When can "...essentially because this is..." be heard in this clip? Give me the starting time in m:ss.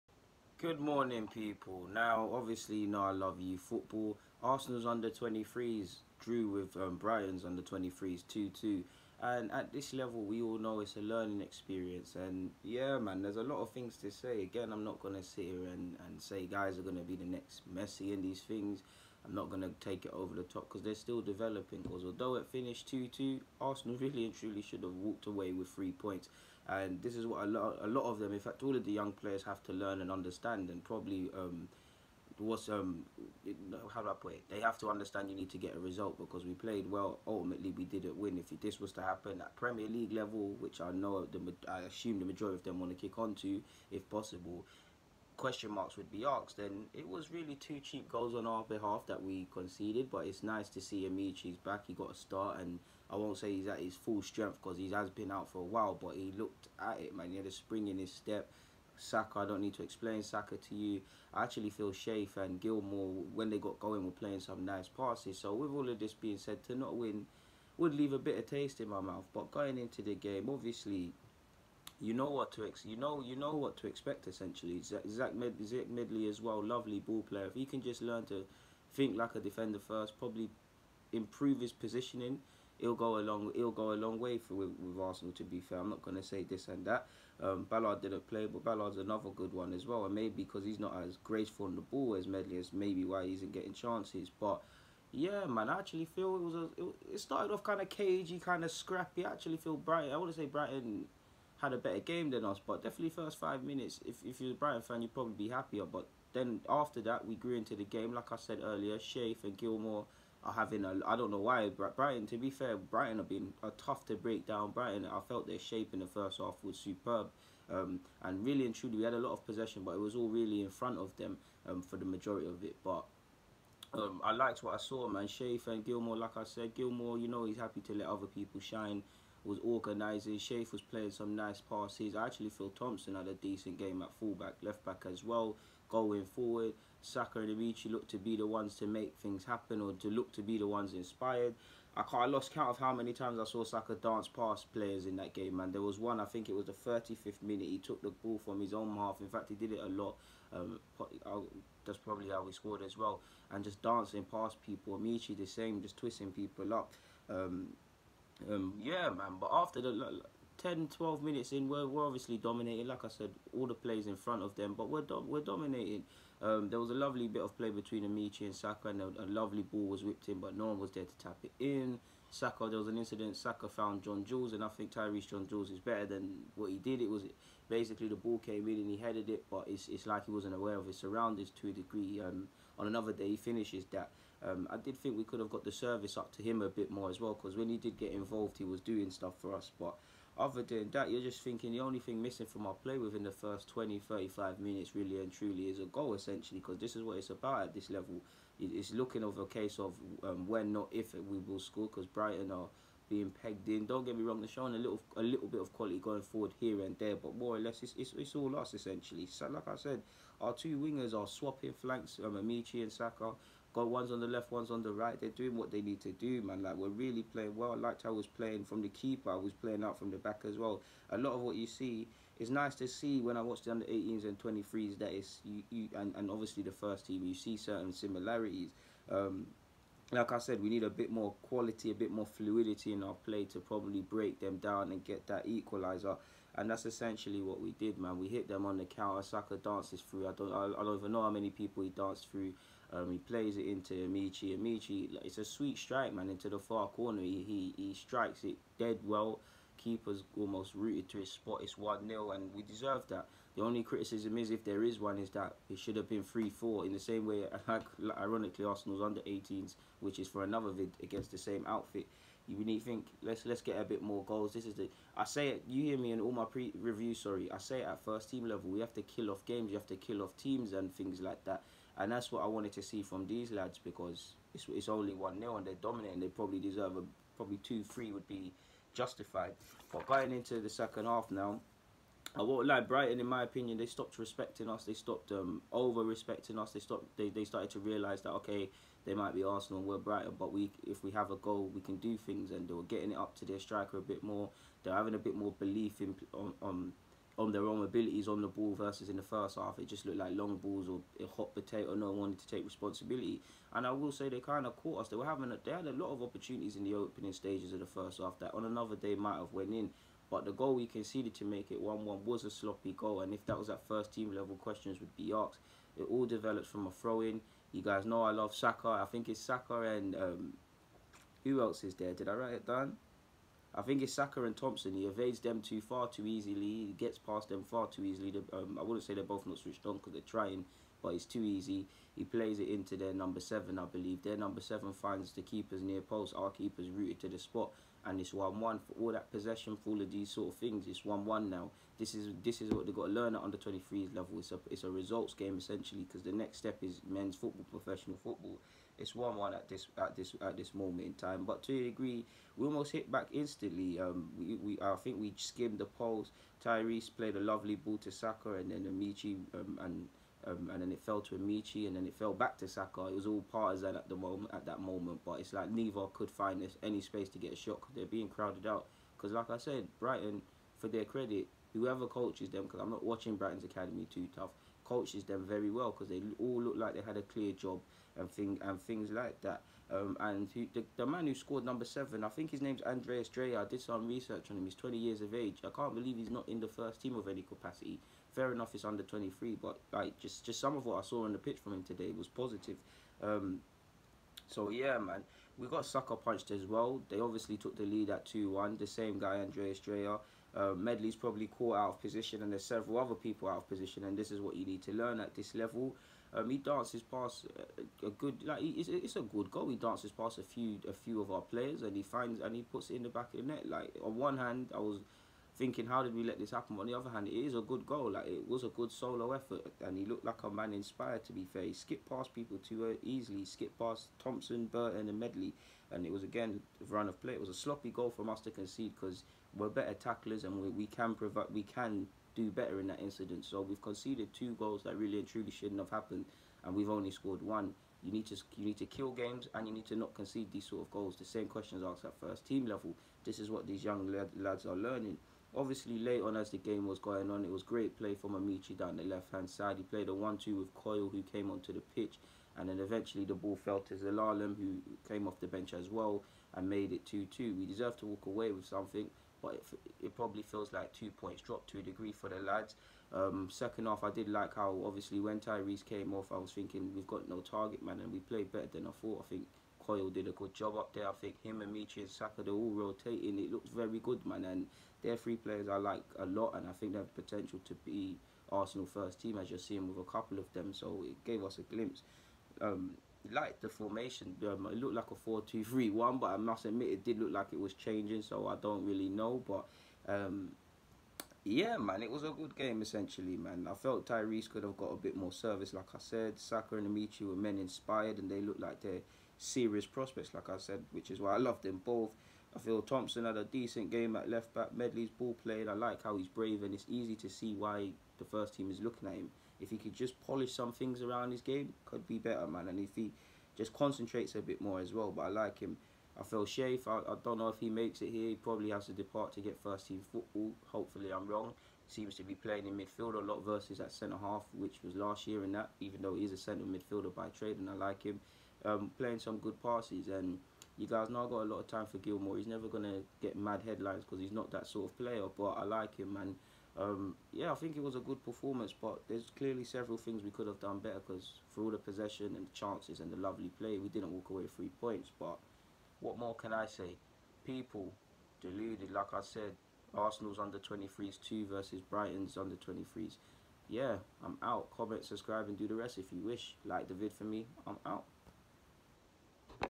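3:16.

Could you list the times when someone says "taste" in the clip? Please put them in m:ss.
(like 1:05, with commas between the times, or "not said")
1:08.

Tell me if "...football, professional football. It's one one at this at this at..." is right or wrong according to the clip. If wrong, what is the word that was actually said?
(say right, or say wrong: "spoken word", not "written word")
right.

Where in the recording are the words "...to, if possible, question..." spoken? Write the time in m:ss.
0:43.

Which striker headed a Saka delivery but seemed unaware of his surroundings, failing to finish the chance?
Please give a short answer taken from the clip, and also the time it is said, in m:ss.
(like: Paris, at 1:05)
Tyreece John Jules, at 2:54.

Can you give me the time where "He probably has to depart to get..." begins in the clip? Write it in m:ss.
8:38.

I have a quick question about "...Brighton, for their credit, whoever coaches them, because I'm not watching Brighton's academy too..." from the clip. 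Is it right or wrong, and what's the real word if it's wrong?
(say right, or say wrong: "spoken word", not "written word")
right.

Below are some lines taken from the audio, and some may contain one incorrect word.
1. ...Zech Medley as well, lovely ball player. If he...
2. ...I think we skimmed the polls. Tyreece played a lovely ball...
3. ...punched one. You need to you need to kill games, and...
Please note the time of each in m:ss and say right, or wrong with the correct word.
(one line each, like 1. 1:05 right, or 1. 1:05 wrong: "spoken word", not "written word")
1. 1:15 right
2. 5:54 right
3. 7:17 wrong: "scored", not "punched".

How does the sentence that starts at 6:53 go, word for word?
Like on one hand, I was thinking, how did we let this happen?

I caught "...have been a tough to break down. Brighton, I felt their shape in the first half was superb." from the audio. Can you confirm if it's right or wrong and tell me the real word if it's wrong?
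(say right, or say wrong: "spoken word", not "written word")
right.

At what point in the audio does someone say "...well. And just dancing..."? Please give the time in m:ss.
2:32.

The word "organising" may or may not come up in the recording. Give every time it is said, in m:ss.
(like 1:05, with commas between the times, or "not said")
2:09.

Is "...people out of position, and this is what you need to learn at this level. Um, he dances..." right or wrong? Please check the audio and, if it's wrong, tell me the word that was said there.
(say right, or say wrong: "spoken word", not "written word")
right.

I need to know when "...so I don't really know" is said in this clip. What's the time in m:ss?
8:08.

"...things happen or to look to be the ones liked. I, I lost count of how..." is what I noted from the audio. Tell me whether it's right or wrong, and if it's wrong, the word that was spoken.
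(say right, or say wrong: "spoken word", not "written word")
wrong: "inspired", not "liked".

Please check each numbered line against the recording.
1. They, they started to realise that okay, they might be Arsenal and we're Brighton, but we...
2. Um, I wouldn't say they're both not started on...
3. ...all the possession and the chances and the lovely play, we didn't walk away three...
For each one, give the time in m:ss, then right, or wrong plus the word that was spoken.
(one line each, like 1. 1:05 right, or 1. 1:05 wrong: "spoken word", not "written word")
1. 4:47 right
2. 5:28 wrong: "switched", not "started"
3. 9:01 right.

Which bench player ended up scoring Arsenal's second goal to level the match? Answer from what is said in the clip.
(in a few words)
Zelalem.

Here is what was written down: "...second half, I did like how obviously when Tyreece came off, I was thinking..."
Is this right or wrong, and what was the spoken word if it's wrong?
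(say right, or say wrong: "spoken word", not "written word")
right.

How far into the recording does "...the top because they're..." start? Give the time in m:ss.
0:20.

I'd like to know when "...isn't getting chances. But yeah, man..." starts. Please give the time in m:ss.
1:33.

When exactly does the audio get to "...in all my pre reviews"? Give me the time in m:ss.
4:26.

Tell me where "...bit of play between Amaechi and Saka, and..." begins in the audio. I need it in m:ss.
2:47.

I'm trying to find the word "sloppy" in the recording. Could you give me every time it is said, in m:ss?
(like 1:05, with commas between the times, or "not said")
5:12, 7:07.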